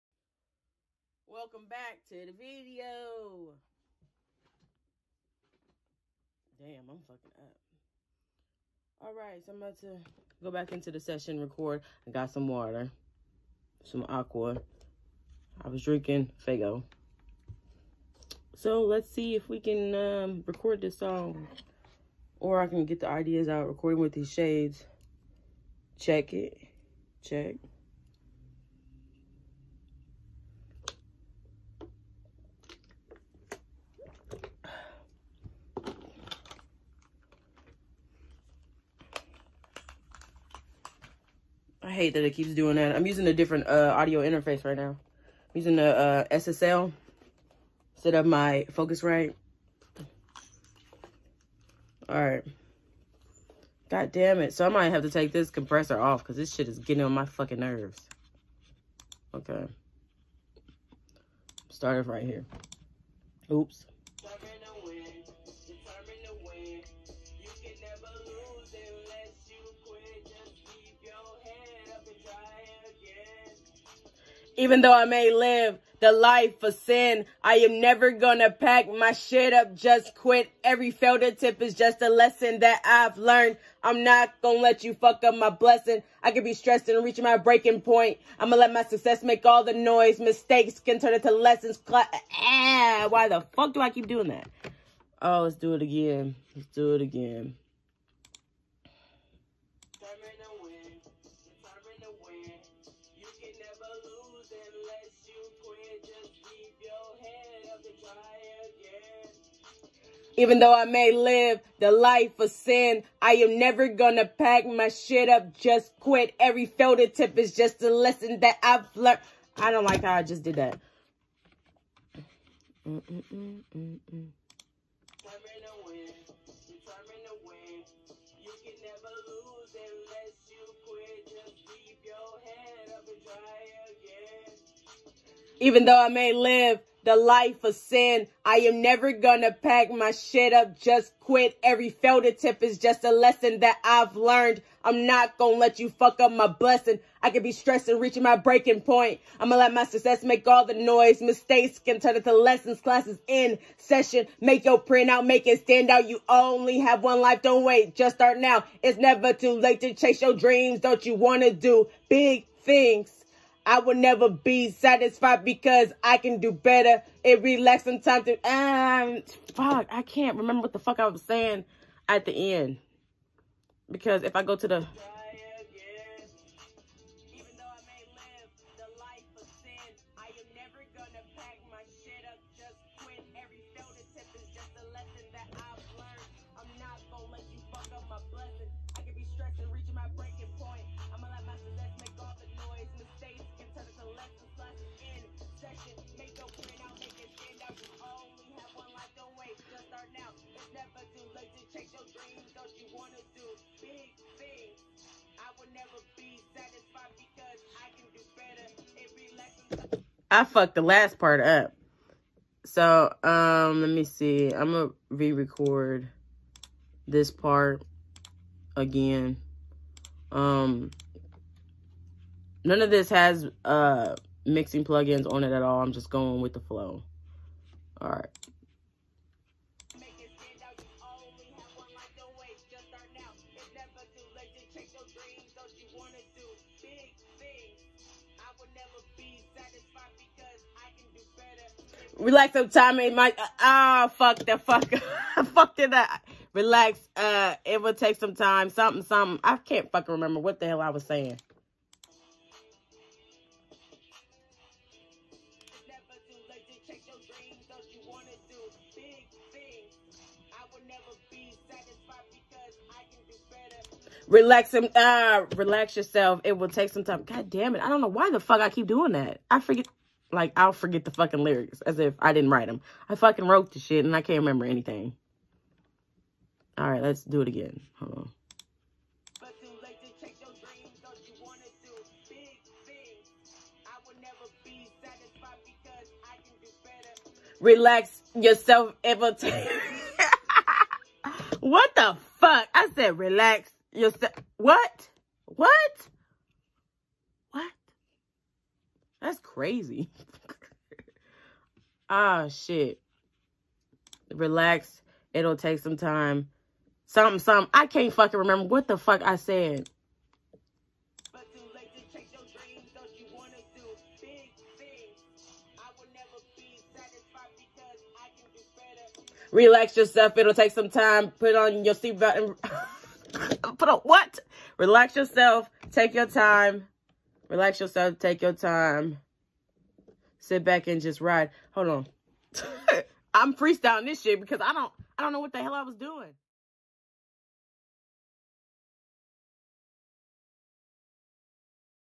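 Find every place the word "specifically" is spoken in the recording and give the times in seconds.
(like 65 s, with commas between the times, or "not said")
not said.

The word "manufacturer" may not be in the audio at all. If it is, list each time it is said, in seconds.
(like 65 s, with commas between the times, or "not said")
not said.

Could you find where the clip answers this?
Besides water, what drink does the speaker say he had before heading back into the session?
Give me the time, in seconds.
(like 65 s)
16 s.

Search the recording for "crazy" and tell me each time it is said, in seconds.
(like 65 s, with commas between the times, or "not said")
299 s.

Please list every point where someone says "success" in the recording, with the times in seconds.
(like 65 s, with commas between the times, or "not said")
88 s, 149 s.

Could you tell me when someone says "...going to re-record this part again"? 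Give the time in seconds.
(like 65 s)
214 s.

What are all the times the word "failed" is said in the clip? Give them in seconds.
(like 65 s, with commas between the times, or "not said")
80 s, 141 s.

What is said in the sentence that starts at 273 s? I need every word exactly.
I fucking wrote the shit and I can't remember anything.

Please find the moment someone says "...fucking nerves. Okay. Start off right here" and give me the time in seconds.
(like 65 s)
57 s.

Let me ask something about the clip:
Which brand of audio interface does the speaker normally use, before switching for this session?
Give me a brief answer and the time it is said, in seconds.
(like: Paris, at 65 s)
Focusrite, at 48 s.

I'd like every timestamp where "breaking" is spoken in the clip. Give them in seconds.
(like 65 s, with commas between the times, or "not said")
87 s, 148 s.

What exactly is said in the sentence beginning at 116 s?
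Every filter tip is just a lesson that I've learned.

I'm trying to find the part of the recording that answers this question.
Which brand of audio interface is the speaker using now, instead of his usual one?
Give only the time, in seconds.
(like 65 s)
46 s.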